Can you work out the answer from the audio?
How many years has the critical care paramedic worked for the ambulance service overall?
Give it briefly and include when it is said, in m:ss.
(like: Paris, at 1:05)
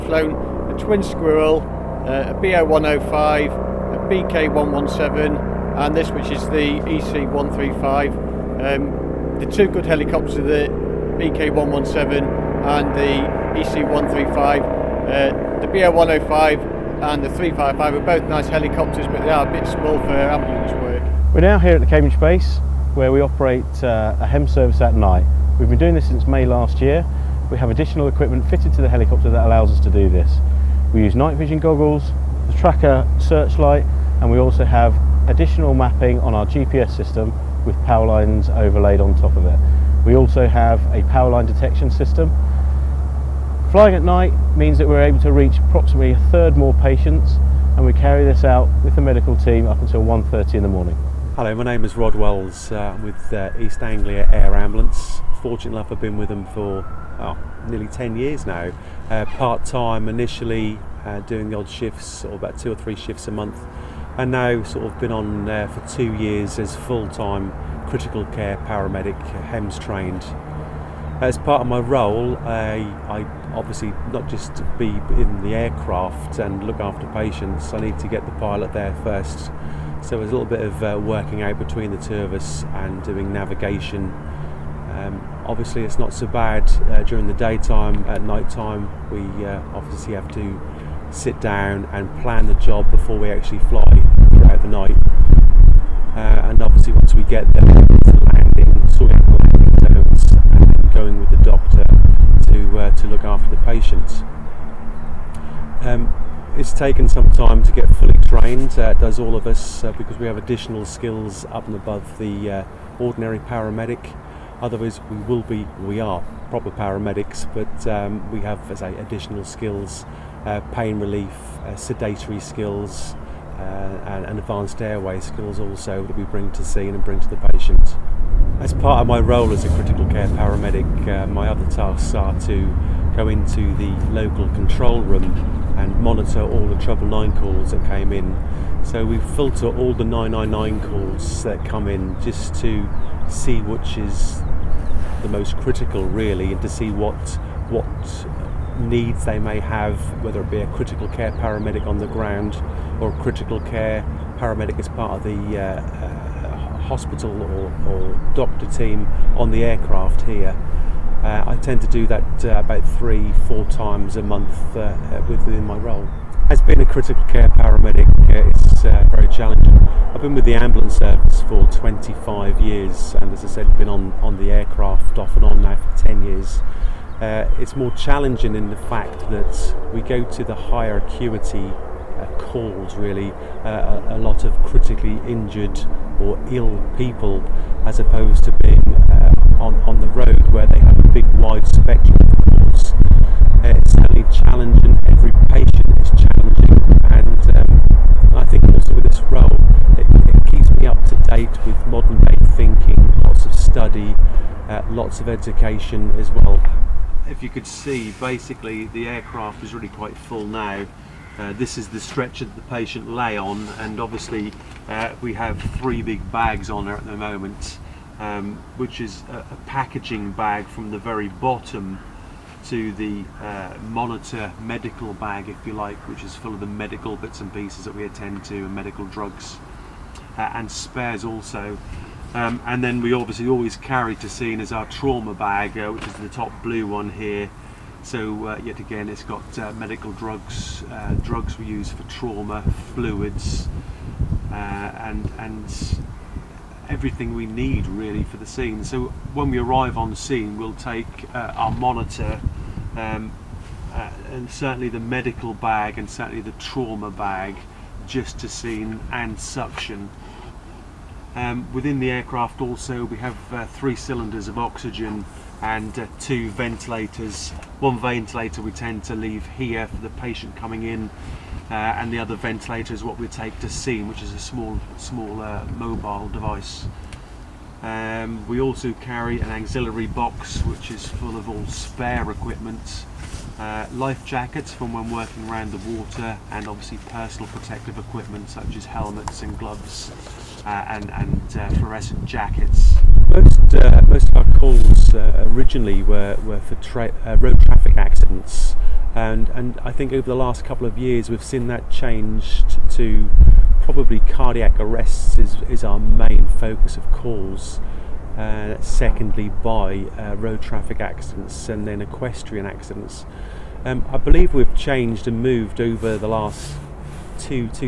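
25, at 2:51.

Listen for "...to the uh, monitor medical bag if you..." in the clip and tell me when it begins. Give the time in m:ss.
3:42.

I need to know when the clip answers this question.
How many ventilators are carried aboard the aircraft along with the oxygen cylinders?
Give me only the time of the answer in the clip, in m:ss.
4:26.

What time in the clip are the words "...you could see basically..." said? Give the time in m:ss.
3:27.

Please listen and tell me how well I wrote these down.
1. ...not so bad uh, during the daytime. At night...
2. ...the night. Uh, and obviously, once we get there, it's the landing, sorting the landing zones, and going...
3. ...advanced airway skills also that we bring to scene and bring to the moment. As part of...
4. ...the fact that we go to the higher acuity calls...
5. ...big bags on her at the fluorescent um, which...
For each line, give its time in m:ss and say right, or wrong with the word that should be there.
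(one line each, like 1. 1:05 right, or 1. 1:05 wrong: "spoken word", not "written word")
1. 1:25 right
2. 1:34 right
3. 2:04 wrong: "patient", not "moment"
4. 2:58 right
5. 3:36 wrong: "moment", not "fluorescent".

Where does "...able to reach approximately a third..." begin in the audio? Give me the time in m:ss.
0:45.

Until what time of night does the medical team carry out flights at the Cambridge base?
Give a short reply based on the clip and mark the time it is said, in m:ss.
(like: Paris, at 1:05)
1:30 in the morning, at 0:50.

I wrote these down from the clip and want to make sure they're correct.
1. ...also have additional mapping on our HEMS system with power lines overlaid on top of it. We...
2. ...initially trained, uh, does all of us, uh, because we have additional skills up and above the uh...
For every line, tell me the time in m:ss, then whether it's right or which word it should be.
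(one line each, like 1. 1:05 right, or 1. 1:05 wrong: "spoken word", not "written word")
1. 0:34 wrong: "GPS", not "HEMS"
2. 1:47 wrong: "fully", not "initially".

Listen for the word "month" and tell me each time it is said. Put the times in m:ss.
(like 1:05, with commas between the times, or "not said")
1:03, 2:44.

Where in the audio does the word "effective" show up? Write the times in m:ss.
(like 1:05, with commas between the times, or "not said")
not said.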